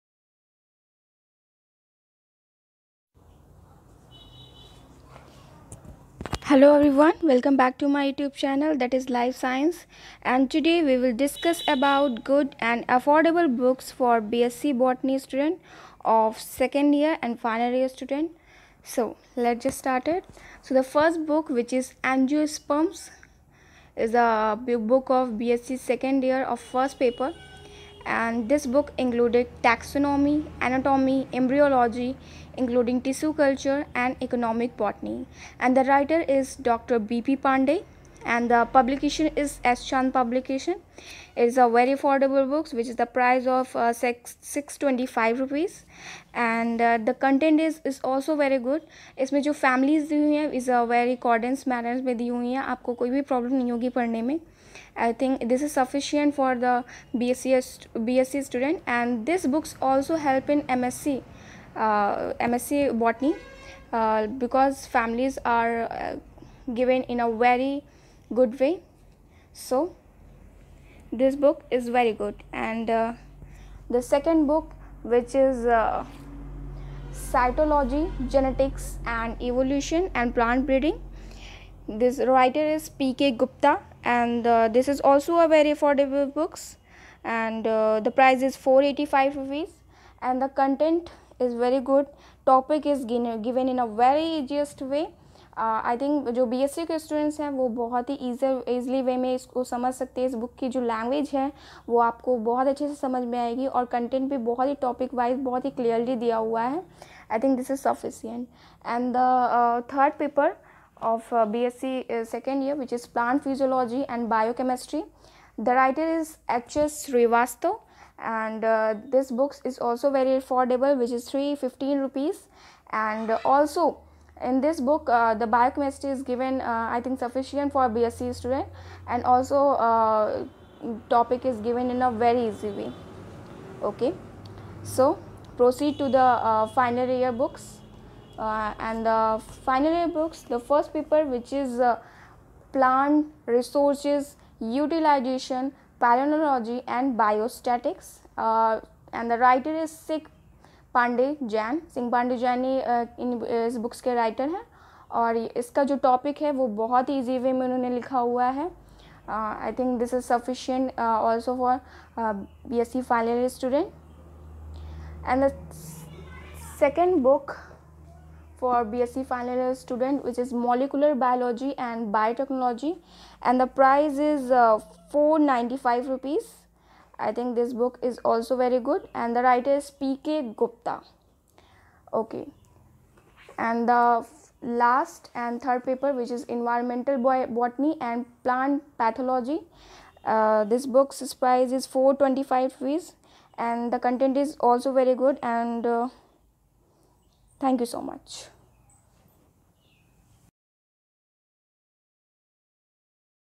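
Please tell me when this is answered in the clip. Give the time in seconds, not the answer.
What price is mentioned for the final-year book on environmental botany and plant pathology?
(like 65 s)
191 s.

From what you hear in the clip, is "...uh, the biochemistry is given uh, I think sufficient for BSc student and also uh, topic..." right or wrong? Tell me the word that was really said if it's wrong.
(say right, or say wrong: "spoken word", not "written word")
right.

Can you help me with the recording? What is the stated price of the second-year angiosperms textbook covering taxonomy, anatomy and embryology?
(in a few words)
625 rupees.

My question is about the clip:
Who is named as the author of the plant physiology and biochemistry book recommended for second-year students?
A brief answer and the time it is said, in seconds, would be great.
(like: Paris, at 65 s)
H.S. Srivastav, at 116 s.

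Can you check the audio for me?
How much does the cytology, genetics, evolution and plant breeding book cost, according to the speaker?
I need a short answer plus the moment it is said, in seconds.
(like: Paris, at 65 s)
485 rupees, at 88 s.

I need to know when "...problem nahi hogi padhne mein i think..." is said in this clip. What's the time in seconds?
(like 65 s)
53 s.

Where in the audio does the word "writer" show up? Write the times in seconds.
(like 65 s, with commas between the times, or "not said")
35 s, 82 s, 115 s, 149 s, 179 s.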